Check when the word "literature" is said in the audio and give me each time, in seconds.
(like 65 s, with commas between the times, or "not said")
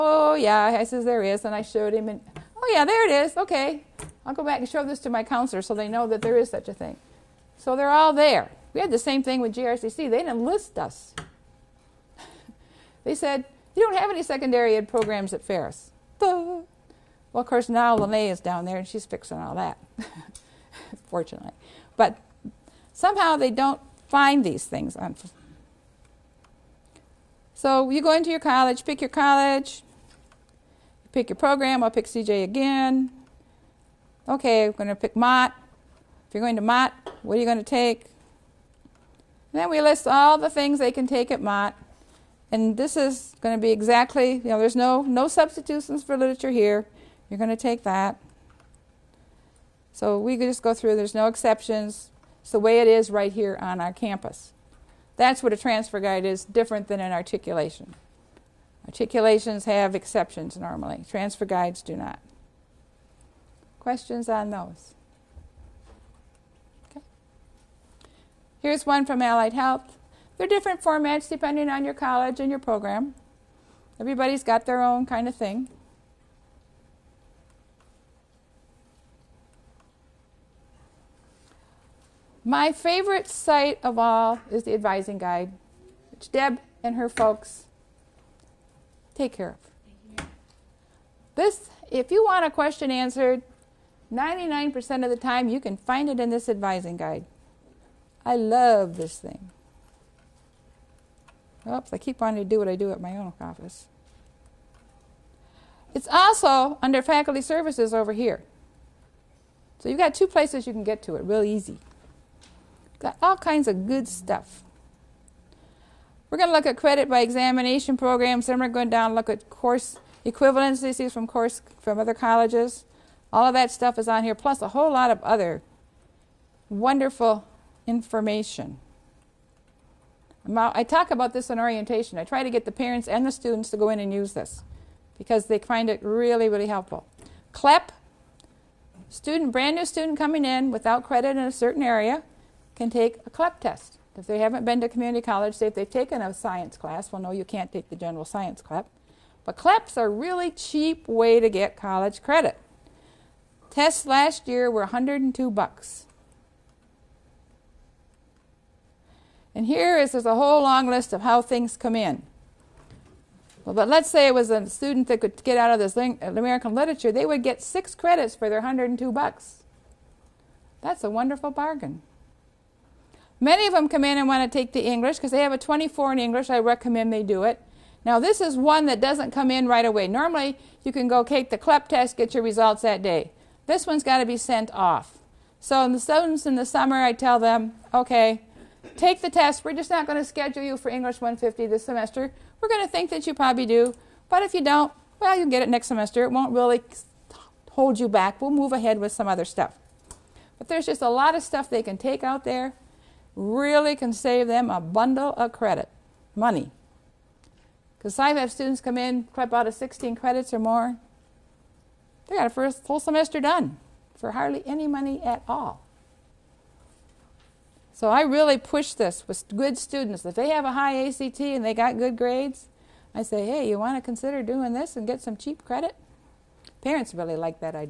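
46 s, 166 s.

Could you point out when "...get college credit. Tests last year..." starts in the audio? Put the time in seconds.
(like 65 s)
151 s.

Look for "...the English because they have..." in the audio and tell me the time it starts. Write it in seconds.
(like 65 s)
174 s.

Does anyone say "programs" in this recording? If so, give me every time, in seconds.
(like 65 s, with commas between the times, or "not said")
14 s, 31 s, 72 s, 117 s.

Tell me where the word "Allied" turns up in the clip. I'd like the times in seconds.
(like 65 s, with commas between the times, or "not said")
69 s.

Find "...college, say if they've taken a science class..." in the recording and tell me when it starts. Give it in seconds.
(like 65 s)
145 s.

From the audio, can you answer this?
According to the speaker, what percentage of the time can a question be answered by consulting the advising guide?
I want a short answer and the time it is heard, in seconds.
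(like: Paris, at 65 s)
99%, at 94 s.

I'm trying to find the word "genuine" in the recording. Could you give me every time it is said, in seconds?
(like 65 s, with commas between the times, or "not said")
not said.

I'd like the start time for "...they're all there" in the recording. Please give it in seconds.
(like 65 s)
7 s.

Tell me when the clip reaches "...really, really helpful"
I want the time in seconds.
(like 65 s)
136 s.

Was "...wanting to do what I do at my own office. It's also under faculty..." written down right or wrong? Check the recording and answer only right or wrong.
right.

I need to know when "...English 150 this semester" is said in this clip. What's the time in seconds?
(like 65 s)
190 s.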